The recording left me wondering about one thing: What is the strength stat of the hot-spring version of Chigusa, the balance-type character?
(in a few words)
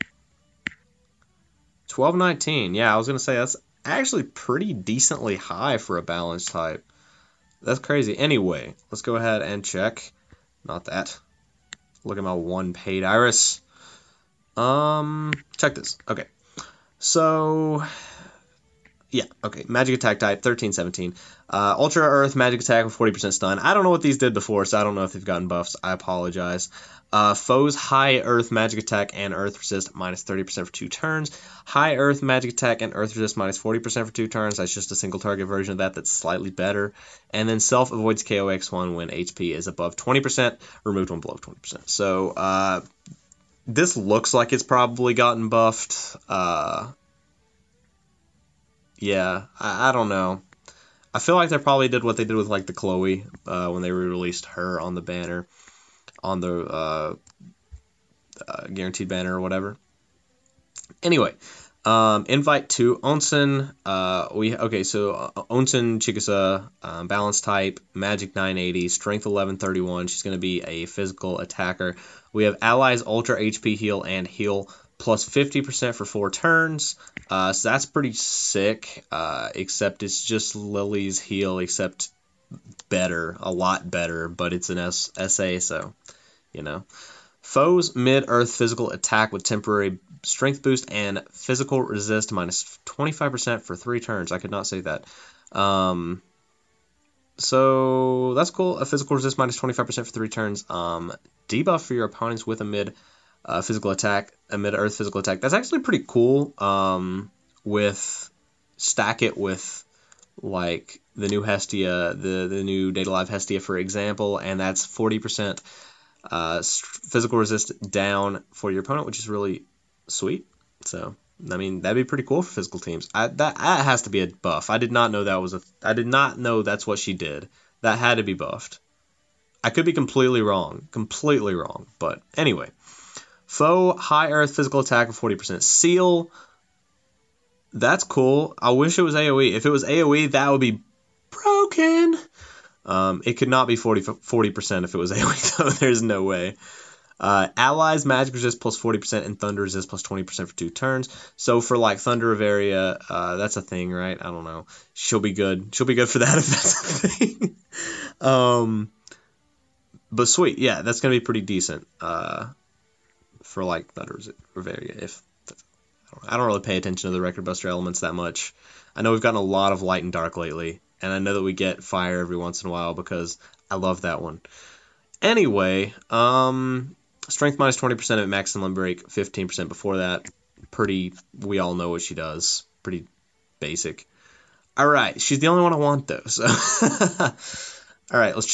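1131.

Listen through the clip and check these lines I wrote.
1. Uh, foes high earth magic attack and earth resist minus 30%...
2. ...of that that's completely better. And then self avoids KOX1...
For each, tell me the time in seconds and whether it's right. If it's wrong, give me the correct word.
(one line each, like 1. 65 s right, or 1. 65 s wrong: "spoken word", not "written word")
1. 27 s right
2. 35 s wrong: "slightly", not "completely".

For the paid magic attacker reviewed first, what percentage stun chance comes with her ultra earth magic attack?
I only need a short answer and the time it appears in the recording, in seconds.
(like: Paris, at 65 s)
40%, at 22 s.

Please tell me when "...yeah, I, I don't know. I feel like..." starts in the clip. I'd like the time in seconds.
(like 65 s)
48 s.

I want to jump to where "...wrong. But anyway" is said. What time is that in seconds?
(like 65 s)
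131 s.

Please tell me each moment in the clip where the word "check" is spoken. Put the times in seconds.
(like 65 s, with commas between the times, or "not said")
9 s, 15 s.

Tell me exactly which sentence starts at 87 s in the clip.
Foes mid earth physical attack with temporary strength boost and physical resist minus 25% for three turns.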